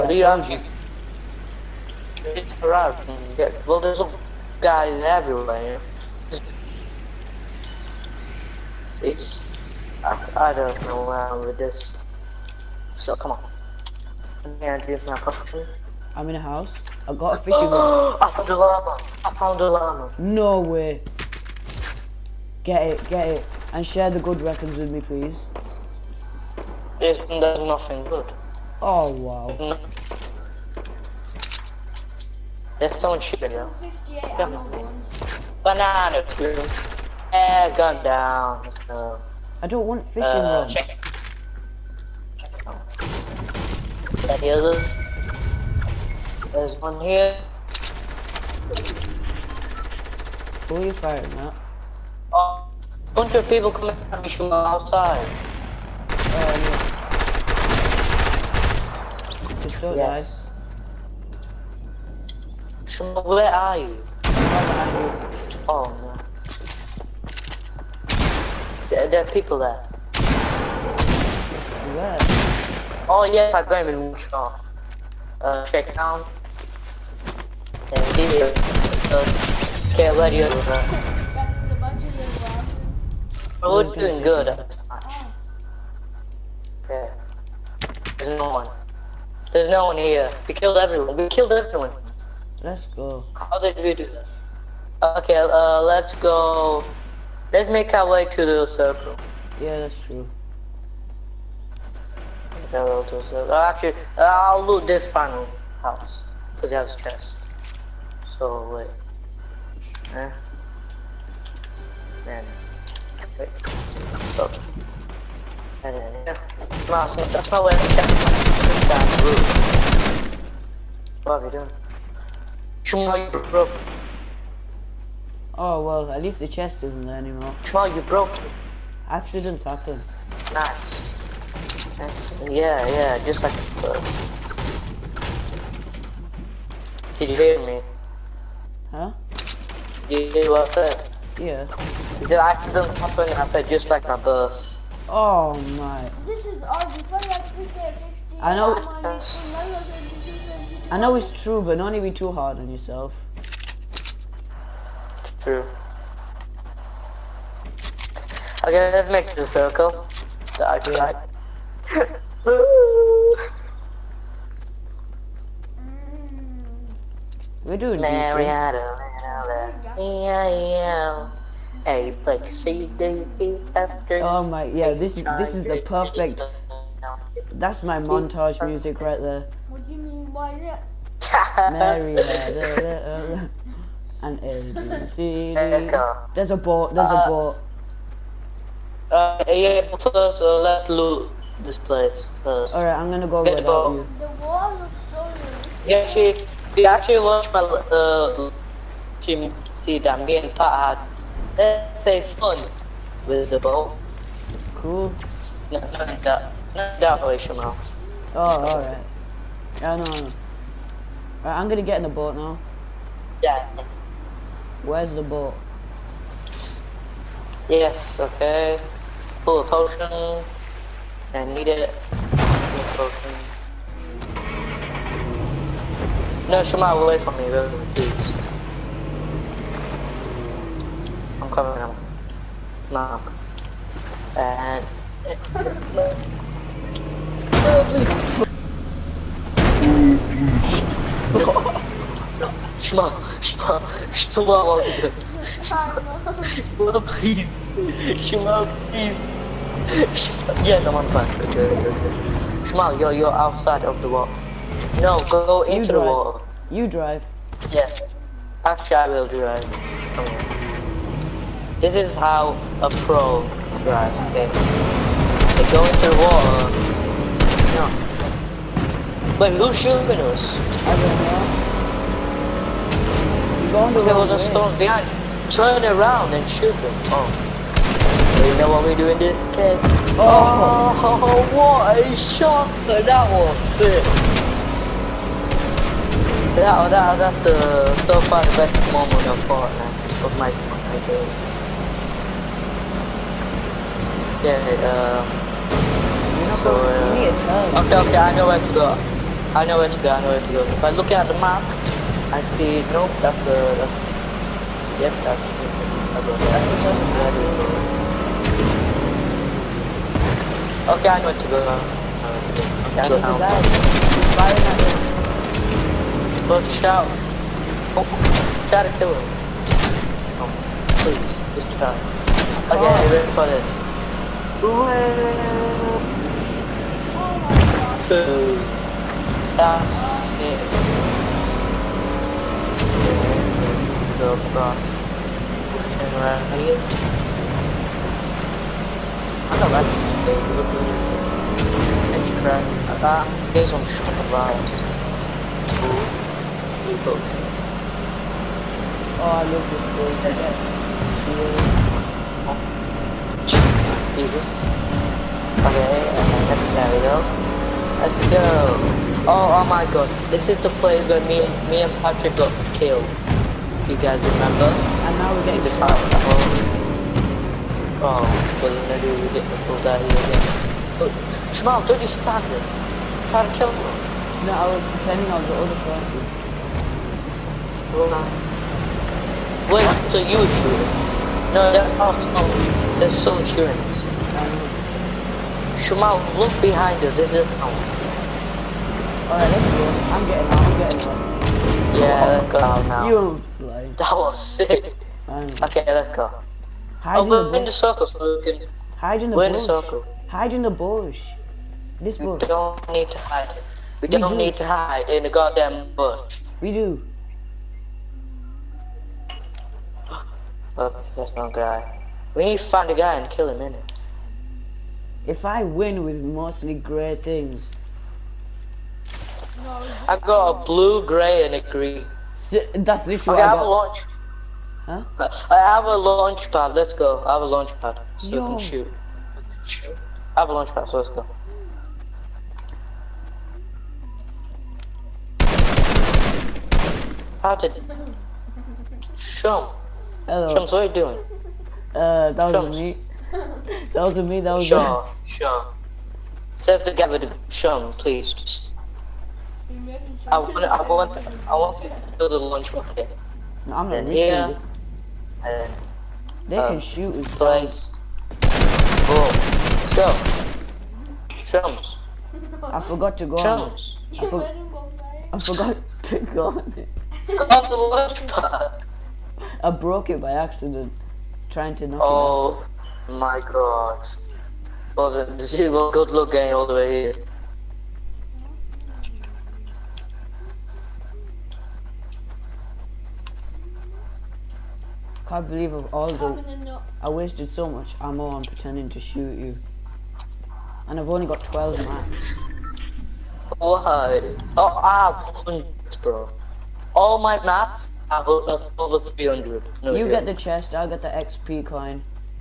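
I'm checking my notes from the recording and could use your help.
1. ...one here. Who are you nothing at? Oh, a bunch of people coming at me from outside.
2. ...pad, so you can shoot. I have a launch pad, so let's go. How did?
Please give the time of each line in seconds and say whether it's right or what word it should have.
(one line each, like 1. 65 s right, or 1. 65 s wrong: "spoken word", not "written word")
1. 46 s wrong: "firing", not "nothing"
2. 427 s right.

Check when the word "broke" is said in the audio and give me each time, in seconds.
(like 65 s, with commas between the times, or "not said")
123 s, 128 s, 469 s.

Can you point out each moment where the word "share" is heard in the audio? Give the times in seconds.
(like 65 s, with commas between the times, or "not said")
23 s.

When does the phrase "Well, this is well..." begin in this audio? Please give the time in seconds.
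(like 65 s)
474 s.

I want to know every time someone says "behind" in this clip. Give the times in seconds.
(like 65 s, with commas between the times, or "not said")
274 s, 386 s.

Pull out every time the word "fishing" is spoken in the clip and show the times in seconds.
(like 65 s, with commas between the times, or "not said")
17 s, 40 s.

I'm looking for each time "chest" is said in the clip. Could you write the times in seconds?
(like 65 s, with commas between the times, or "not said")
106 s, 126 s, 500 s.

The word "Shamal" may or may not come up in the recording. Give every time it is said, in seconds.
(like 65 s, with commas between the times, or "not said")
207 s, 226 s, 385 s.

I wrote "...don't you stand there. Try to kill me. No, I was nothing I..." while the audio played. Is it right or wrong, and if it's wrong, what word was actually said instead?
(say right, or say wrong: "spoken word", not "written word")
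wrong: "pretending", not "nothing".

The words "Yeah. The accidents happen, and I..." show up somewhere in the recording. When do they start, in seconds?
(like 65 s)
141 s.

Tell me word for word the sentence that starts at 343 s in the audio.
these on shot of Blue potion.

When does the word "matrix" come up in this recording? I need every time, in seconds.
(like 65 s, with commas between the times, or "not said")
not said.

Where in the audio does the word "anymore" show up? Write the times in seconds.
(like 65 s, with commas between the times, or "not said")
127 s.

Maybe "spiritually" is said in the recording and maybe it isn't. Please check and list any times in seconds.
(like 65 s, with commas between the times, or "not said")
not said.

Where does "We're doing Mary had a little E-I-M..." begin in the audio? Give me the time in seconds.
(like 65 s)
167 s.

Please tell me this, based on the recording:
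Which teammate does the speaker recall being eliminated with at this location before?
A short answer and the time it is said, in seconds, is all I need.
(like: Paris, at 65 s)
Patrick, at 362 s.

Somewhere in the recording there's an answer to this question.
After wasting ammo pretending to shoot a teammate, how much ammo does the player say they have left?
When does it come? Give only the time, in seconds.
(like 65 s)
490 s.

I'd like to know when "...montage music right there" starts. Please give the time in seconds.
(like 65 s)
177 s.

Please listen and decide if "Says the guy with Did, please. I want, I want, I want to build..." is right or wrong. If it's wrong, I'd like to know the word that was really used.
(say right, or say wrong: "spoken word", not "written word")
wrong: "Shum", not "Did".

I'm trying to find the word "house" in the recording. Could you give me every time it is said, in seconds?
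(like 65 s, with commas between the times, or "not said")
16 s, 105 s.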